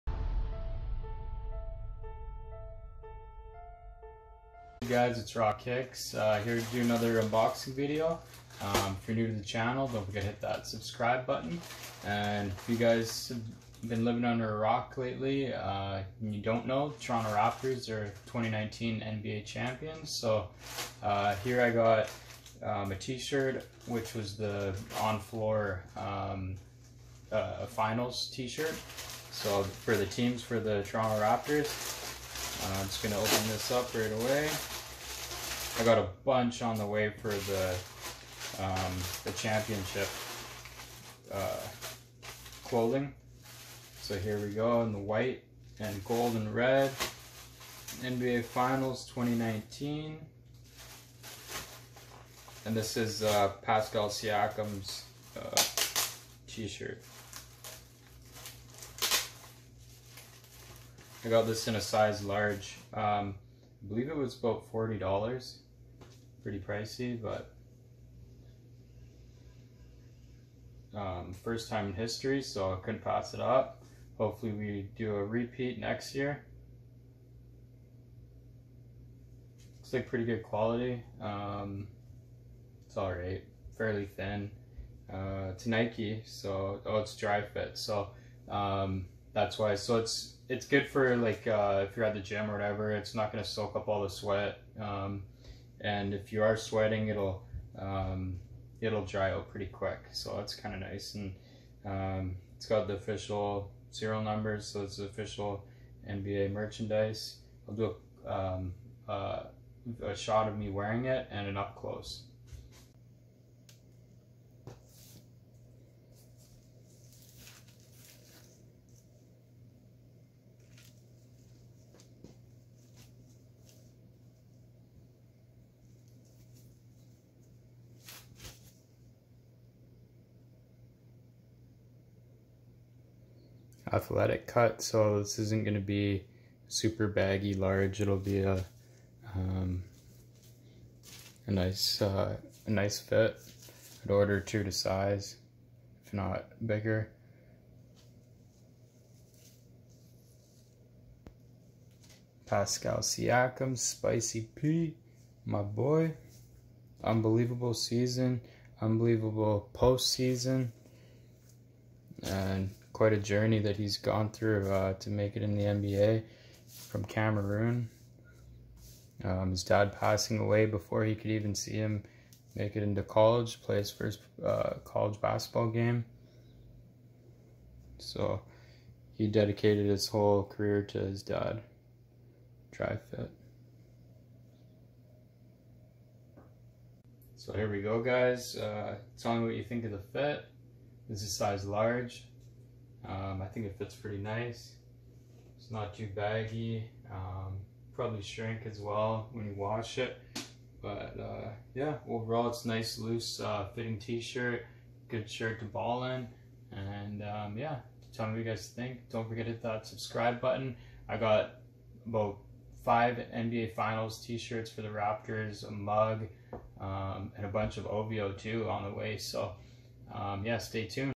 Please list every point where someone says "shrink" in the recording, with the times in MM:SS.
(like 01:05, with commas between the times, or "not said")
03:18.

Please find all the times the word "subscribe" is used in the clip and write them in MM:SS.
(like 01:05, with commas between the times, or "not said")
00:10, 03:29.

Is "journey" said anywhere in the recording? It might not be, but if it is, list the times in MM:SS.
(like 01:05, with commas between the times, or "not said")
02:43.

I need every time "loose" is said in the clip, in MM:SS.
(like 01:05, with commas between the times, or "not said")
03:22.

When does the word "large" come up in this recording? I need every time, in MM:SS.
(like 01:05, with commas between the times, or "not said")
01:02, 02:17, 03:11.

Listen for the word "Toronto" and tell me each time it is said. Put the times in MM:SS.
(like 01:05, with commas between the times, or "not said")
00:16, 00:30.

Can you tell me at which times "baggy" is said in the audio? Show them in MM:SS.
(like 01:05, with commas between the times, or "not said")
02:17, 03:16.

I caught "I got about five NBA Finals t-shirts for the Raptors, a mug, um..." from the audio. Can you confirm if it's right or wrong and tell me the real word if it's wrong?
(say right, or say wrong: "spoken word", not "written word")
right.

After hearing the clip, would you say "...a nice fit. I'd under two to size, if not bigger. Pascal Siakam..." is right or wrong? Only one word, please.
wrong.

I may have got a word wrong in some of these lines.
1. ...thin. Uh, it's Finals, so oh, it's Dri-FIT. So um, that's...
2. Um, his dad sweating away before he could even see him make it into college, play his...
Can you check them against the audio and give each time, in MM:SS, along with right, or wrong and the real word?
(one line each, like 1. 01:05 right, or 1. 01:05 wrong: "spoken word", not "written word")
1. 01:24 wrong: "Nike", not "Finals"
2. 02:49 wrong: "passing", not "sweating".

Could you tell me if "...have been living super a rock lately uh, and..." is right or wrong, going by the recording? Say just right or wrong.
wrong.